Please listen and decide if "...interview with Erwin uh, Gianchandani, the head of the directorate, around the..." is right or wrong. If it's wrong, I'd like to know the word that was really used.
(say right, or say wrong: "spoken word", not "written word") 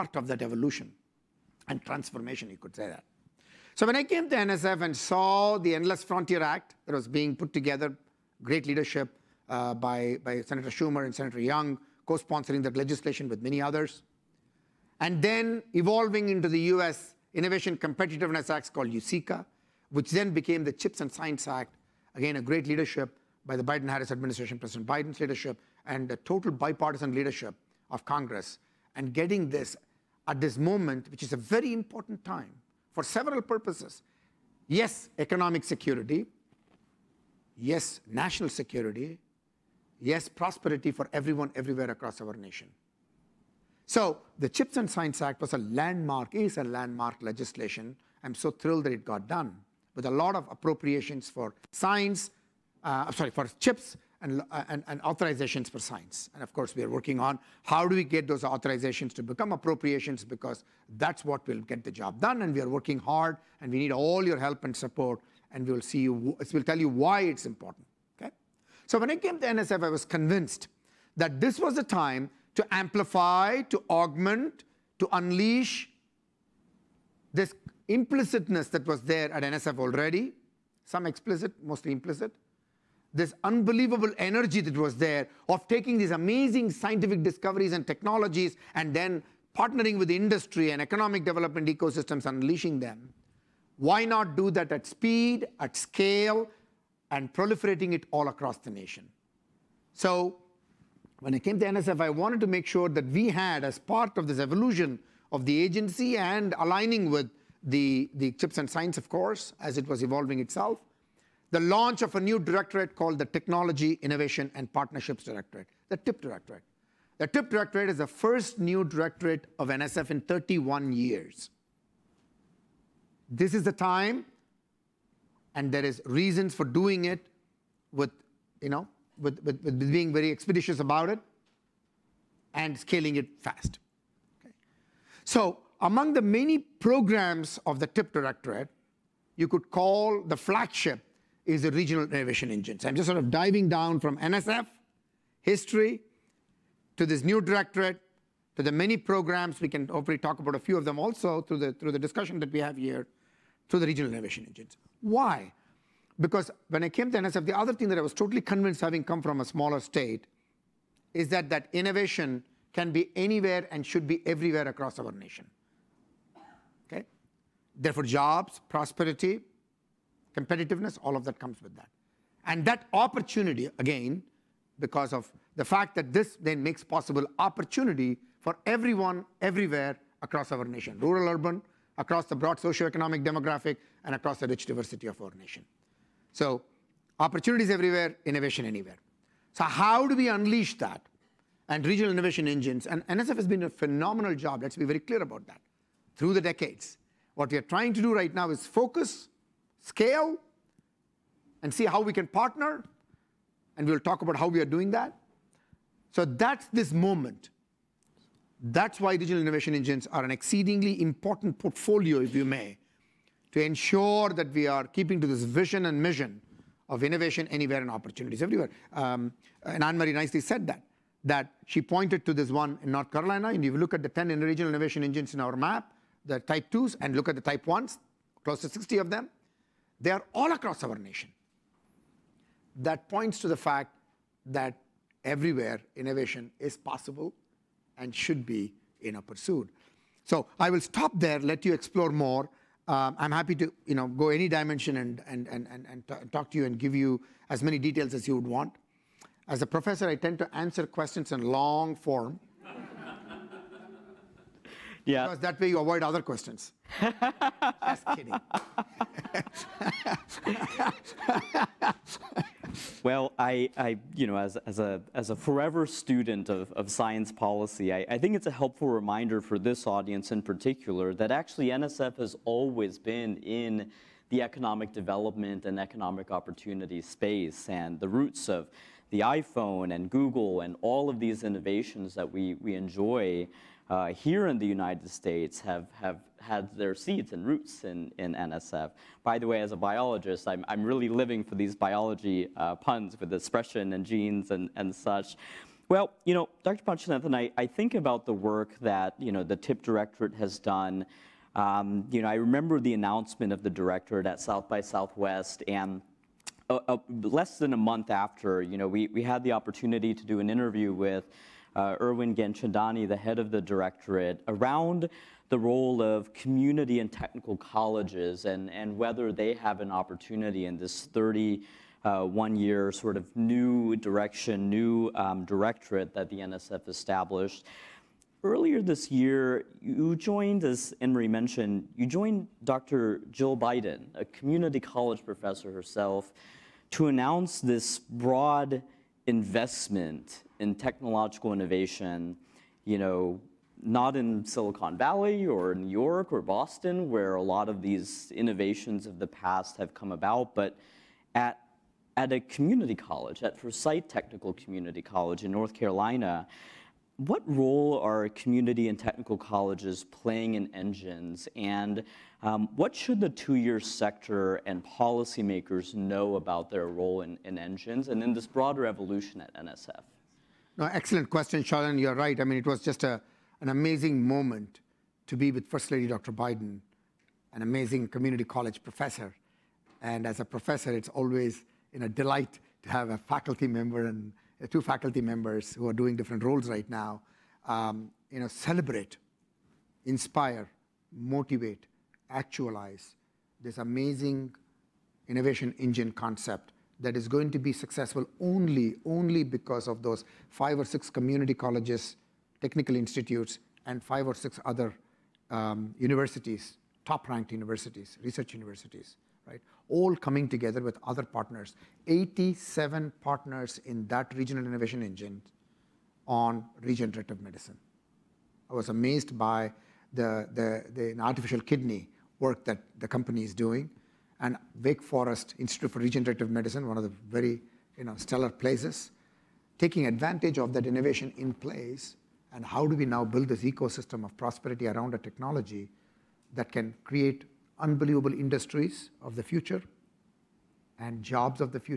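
right.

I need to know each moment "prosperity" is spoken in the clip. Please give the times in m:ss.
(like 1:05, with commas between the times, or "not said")
0:40, 2:48, 7:14.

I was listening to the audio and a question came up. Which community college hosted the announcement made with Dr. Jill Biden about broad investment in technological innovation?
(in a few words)
Forsyth Technical Community College.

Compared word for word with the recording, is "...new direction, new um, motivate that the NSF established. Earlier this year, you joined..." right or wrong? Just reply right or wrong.
wrong.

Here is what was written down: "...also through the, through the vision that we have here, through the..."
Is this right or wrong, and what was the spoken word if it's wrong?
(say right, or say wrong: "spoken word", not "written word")
wrong: "discussion", not "vision".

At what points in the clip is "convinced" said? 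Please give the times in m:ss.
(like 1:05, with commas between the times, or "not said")
1:10, 2:38.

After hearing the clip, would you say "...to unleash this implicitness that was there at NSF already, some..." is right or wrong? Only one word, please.
right.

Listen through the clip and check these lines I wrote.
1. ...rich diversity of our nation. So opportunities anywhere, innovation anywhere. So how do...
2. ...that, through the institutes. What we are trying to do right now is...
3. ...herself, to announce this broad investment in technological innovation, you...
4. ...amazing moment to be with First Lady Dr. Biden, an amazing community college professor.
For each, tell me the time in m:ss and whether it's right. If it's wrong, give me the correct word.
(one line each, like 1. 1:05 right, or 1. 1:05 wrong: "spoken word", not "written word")
1. 3:04 wrong: "everywhere", not "anywhere"
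2. 3:15 wrong: "decades", not "institutes"
3. 5:35 right
4. 6:13 right.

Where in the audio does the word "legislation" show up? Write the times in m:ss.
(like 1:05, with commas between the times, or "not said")
0:12, 0:47.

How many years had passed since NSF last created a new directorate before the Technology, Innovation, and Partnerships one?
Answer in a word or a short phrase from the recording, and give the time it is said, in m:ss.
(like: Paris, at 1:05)
31, at 2:00.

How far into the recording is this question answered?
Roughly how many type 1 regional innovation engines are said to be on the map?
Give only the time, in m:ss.
3:48.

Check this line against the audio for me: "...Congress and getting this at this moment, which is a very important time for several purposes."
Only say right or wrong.
right.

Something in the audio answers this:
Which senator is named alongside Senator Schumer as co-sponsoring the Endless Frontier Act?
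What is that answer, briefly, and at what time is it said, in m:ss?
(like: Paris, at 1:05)
Senator Young, at 0:11.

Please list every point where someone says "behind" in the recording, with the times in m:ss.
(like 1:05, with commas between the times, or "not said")
not said.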